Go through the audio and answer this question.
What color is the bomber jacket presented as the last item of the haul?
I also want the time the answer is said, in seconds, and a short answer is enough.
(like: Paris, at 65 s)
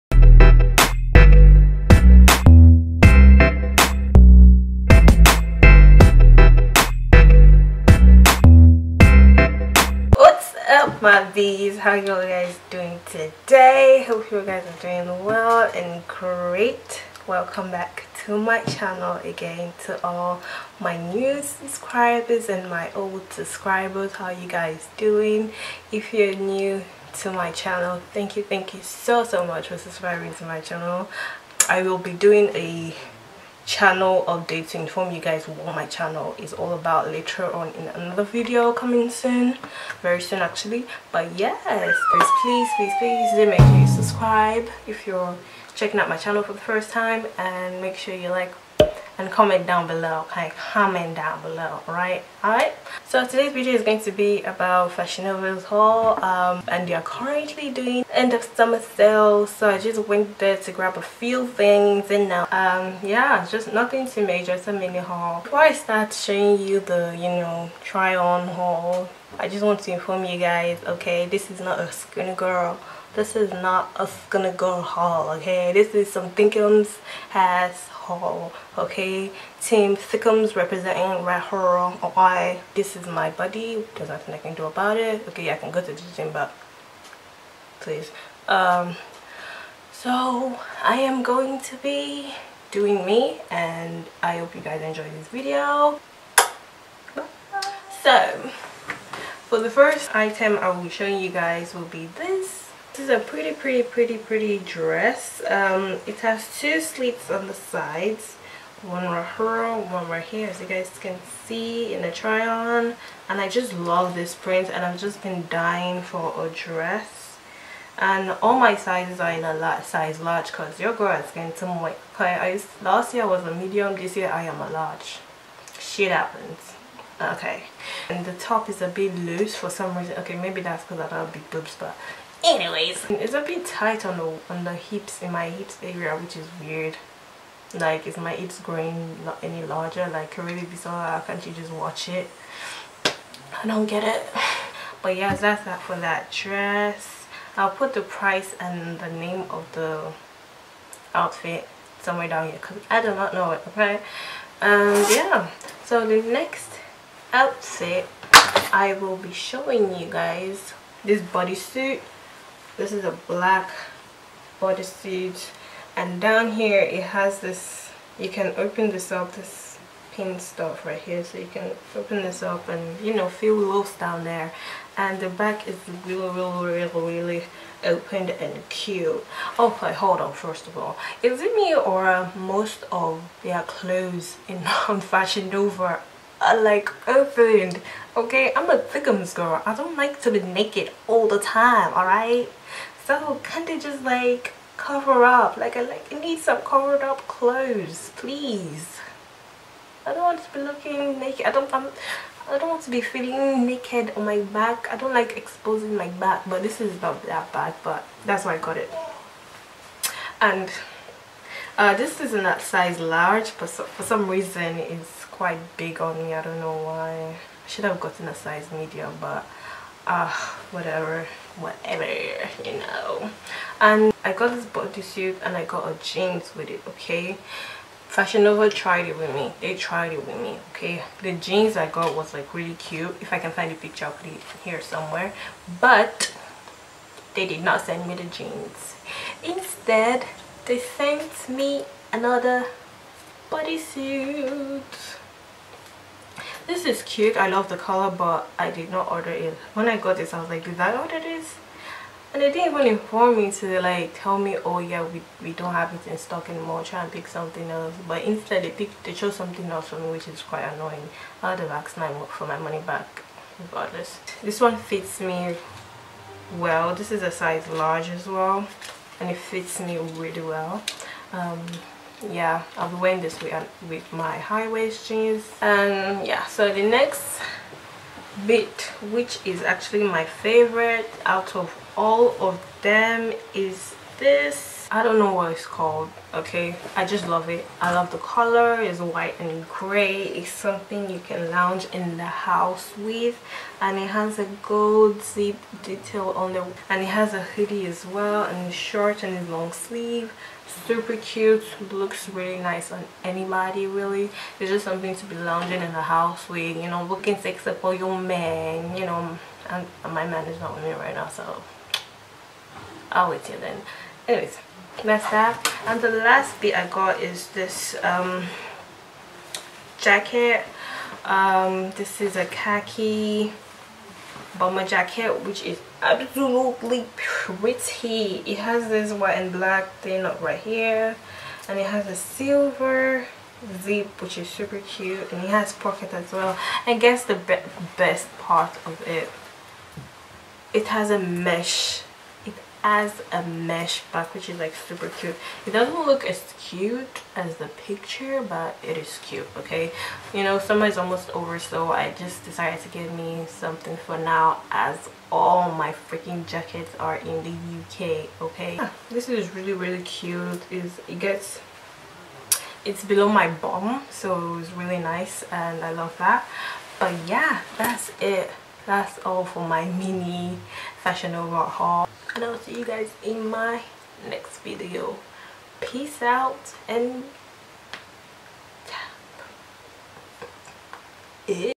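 Khaki, at 322 s.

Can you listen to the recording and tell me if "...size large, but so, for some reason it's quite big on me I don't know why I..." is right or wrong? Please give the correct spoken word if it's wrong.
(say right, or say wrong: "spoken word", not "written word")
right.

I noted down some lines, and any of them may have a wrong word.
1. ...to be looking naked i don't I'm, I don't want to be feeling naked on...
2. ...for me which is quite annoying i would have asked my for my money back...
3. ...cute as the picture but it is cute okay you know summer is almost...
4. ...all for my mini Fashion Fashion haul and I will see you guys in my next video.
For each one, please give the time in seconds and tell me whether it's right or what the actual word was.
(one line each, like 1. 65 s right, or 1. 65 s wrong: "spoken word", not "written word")
1. 200 s right
2. 259 s right
3. 346 s right
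4. 369 s wrong: "Nova", not "Fashion".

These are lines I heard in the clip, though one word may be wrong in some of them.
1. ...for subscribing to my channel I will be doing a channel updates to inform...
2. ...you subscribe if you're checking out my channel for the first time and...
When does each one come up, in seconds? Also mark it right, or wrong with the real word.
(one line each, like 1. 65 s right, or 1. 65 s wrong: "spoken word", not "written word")
1. 29 s right
2. 43 s right.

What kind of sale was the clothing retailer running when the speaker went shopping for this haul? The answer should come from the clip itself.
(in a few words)
End of summer sale.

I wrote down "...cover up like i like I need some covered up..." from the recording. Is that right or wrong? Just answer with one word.
right.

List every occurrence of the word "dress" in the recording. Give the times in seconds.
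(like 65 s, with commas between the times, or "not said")
104 s, 116 s, 146 s.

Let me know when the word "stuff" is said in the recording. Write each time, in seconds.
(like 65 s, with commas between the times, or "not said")
170 s.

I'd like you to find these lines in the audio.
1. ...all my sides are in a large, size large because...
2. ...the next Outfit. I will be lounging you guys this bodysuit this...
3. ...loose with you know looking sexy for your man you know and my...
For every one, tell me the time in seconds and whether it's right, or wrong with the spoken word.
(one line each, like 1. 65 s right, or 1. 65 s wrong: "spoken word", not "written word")
1. 118 s wrong: "sizes", not "sides"
2. 156 s wrong: "showing", not "lounging"
3. 306 s wrong: "house", not "loose".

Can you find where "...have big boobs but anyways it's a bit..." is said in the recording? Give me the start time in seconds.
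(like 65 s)
131 s.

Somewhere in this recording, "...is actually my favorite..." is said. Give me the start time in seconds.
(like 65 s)
279 s.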